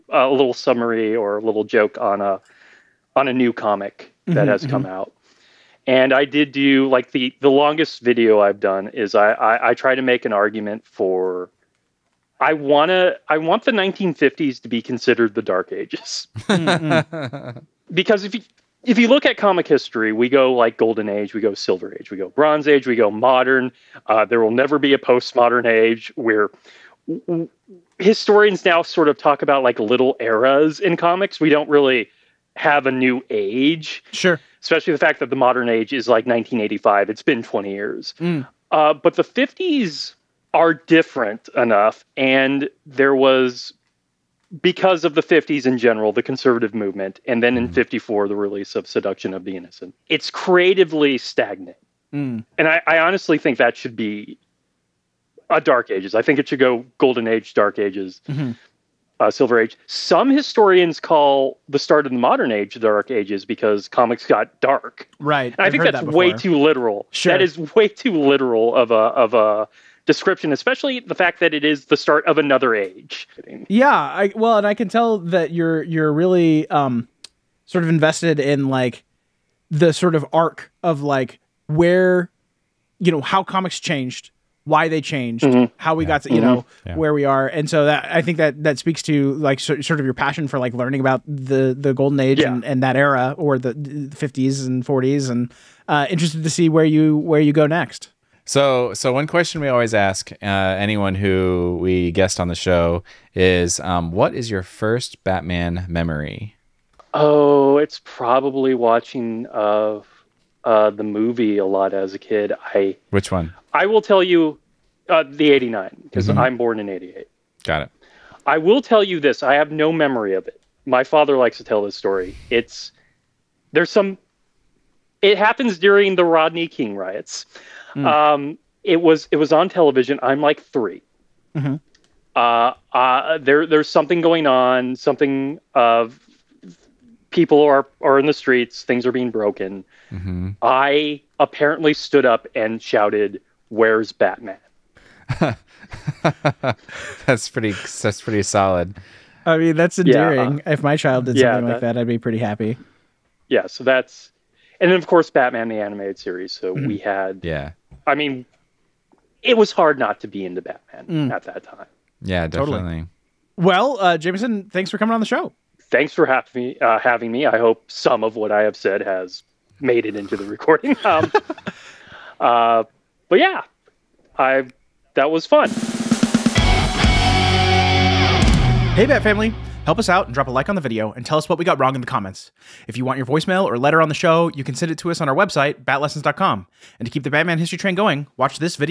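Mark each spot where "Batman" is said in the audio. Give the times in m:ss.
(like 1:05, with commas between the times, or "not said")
1:45, 2:24, 2:35, 2:40, 3:07.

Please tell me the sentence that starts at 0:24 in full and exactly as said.
Uh, there will never be a postmodern age.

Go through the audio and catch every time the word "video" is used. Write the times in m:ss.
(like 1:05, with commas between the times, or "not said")
0:08, 3:00.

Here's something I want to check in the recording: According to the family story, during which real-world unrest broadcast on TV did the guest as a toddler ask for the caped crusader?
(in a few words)
Rodney King riots.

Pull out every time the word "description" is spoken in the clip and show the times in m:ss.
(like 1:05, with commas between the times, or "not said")
1:10.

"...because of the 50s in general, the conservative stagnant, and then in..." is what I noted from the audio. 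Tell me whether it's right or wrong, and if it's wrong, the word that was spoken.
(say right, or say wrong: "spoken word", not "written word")
wrong: "movement", not "stagnant".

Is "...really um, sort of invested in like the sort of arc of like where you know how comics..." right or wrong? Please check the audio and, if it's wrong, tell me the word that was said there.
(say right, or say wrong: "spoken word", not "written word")
right.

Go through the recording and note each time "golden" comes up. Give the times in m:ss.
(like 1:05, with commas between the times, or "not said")
0:20, 0:56, 1:31.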